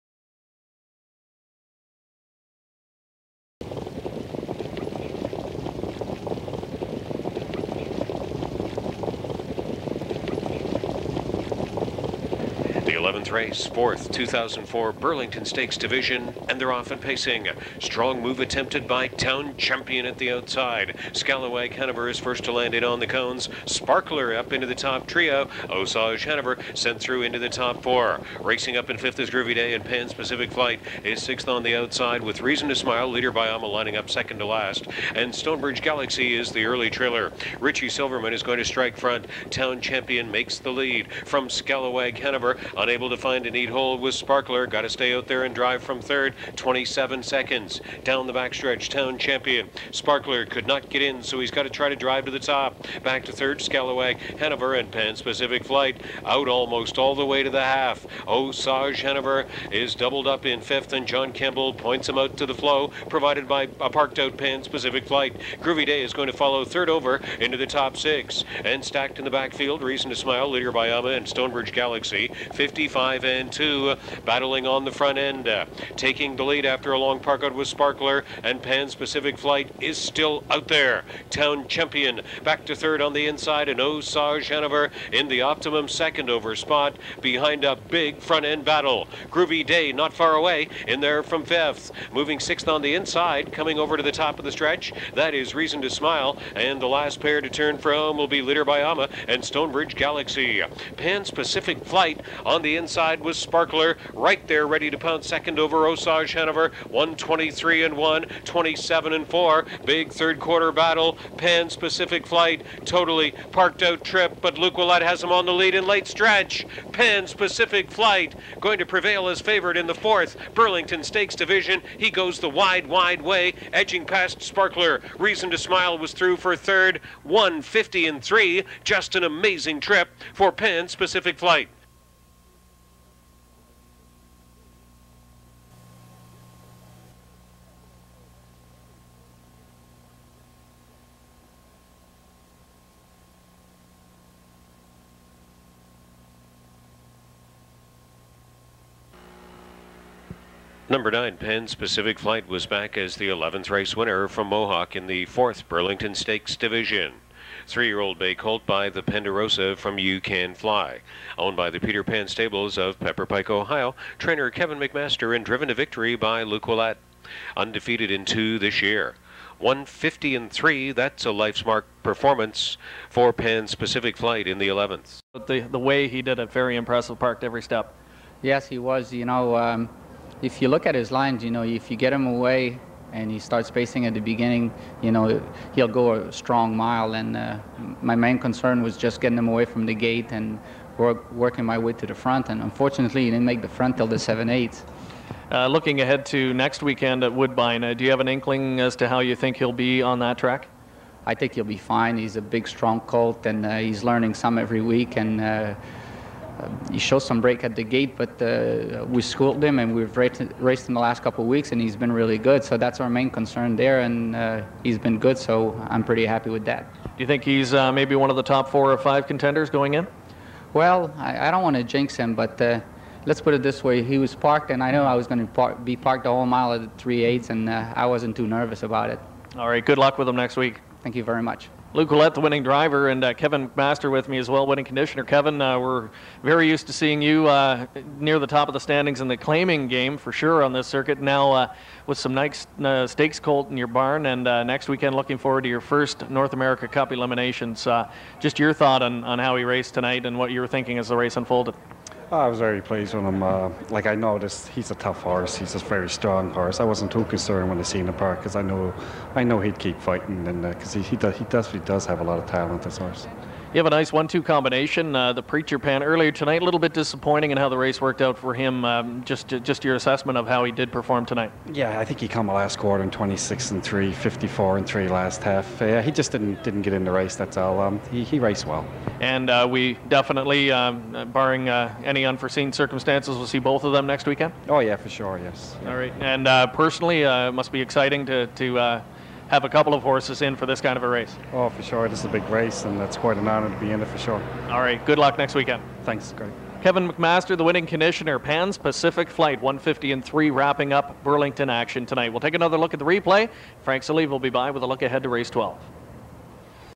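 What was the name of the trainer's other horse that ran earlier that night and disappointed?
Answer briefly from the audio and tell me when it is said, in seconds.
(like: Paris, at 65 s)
Preacher Pan, at 265 s.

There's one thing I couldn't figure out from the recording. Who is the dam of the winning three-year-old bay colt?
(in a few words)
You Can Fly.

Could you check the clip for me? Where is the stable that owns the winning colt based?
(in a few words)
Pepper Pike, Ohio.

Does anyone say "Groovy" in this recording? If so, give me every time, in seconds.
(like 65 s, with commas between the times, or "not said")
29 s, 65 s, 89 s.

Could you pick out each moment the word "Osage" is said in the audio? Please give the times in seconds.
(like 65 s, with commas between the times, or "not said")
25 s, 58 s, 83 s, 105 s.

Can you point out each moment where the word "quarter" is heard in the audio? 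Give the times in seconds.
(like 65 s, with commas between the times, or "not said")
110 s, 272 s.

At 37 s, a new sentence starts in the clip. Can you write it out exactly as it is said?
Richie Silverman is going to strike front.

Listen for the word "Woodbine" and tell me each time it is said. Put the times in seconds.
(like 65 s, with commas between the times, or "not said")
197 s.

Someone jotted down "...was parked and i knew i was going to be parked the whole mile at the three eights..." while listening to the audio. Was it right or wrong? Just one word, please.
right.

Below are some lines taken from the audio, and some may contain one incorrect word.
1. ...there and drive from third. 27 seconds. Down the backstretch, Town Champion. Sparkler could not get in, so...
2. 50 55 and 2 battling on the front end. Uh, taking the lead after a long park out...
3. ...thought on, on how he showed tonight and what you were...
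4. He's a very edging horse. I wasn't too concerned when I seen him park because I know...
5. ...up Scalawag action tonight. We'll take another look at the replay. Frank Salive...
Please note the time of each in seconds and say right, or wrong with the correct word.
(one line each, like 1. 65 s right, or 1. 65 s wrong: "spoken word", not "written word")
1. 45 s right
2. 72 s right
3. 248 s wrong: "raced", not "showed"
4. 255 s wrong: "strong", not "edging"
5. 300 s wrong: "Burlington", not "Scalawag".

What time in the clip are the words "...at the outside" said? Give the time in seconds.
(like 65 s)
20 s.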